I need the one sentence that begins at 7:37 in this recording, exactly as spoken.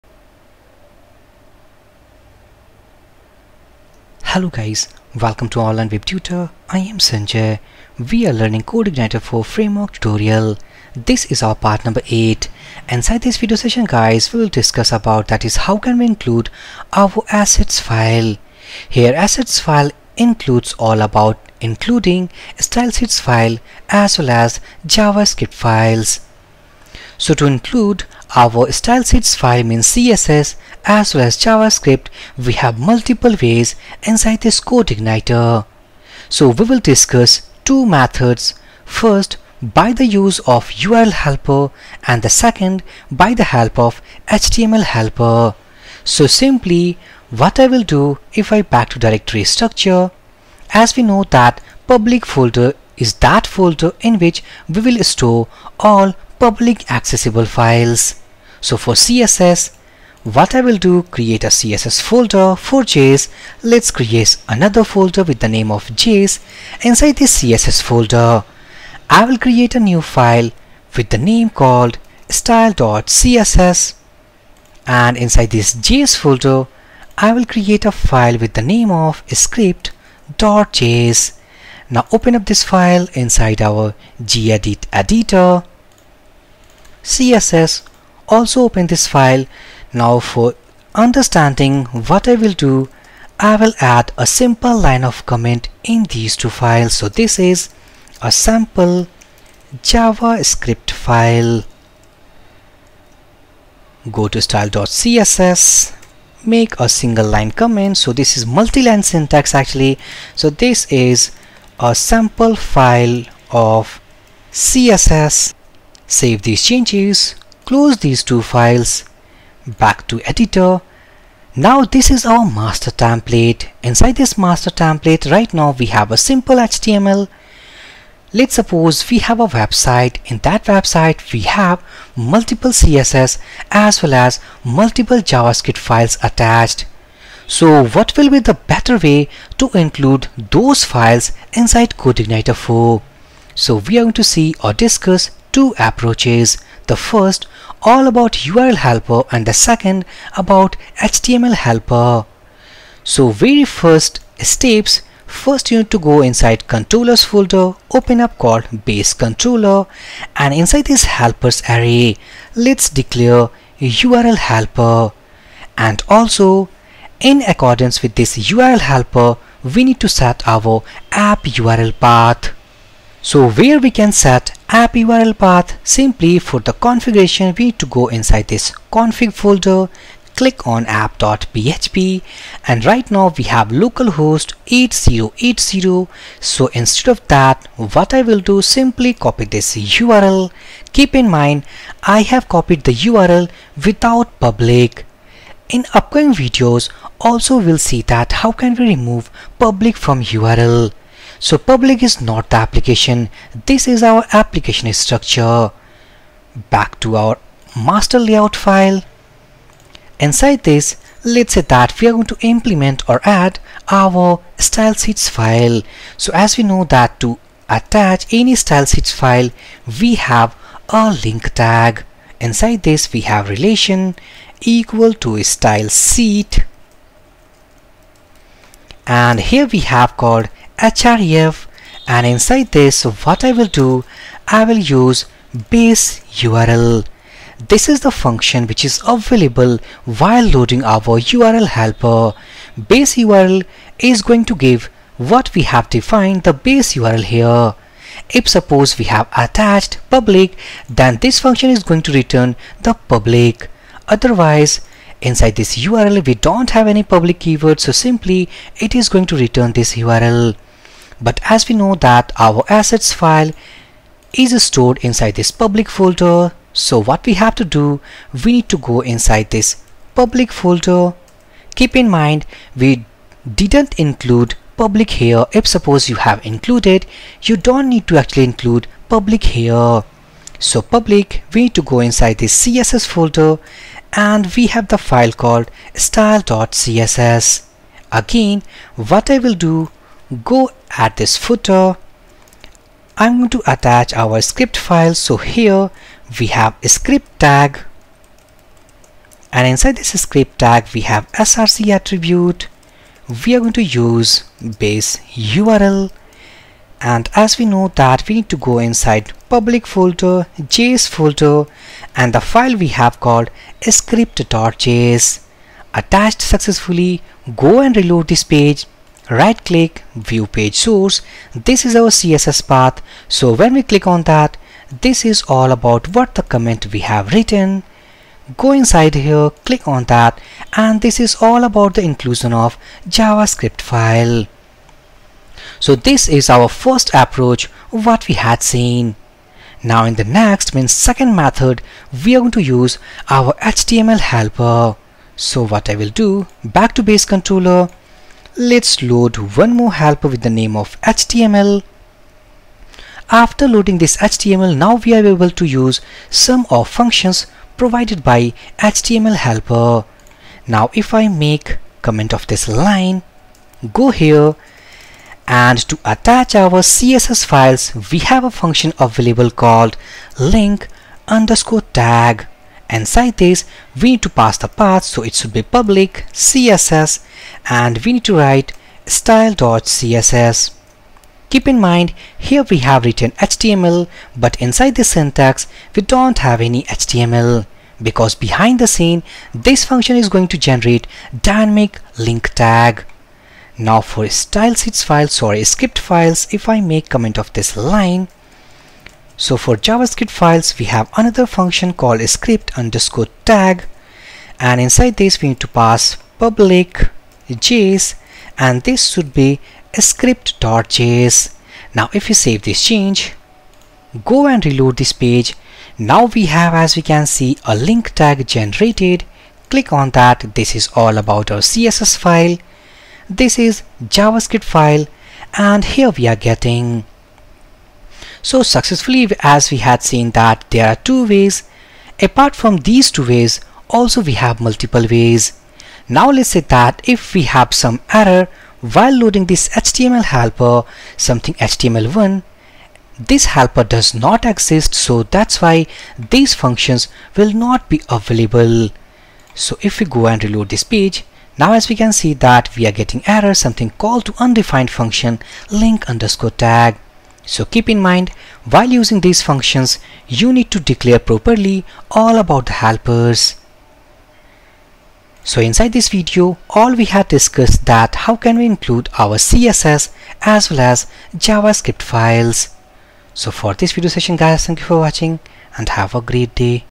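So keep in mind, while using these functions, you need to declare properly all about the helpers.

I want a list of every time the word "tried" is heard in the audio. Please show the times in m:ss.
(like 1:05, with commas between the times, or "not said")
not said.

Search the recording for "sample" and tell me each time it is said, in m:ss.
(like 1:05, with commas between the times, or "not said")
1:38, 1:51.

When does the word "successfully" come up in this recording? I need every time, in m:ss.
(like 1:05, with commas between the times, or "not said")
5:16, 7:08.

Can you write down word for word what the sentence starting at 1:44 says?
Go to style.css, make a single line comment.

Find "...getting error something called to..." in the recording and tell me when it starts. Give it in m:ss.
7:32.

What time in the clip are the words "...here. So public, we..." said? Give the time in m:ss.
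4:39.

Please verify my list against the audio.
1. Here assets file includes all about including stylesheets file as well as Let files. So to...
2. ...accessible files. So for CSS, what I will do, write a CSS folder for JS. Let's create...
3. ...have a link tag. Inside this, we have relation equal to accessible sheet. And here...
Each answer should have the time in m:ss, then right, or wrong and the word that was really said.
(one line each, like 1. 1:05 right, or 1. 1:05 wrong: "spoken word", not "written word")
1. 0:18 wrong: "JavaScript", not "Let"
2. 0:56 wrong: "create", not "write"
3. 3:40 wrong: "style", not "accessible".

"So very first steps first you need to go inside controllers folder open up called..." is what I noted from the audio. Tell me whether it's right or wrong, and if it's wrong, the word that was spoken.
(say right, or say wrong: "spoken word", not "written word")
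right.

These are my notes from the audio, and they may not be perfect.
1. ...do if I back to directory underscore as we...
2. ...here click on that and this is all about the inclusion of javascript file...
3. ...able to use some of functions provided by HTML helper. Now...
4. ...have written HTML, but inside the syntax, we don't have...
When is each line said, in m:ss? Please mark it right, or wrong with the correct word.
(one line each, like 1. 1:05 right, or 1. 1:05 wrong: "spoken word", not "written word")
1. 0:47 wrong: "structure", not "underscore"
2. 5:29 right
3. 5:55 right
4. 6:22 right.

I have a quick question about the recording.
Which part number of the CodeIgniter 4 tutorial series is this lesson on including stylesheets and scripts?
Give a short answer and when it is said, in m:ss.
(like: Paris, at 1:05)
8, at 0:12.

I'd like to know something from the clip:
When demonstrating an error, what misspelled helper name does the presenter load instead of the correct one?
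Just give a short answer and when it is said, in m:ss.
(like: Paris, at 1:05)
HTML1, at 7:21.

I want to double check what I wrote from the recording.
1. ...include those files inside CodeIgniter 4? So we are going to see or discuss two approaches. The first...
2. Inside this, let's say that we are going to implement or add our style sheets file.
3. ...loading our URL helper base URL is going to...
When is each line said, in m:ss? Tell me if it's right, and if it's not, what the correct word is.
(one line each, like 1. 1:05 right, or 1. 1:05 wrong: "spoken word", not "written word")
1. 2:19 right
2. 3:30 right
3. 4:00 right.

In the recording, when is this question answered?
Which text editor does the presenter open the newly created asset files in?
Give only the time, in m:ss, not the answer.
1:24.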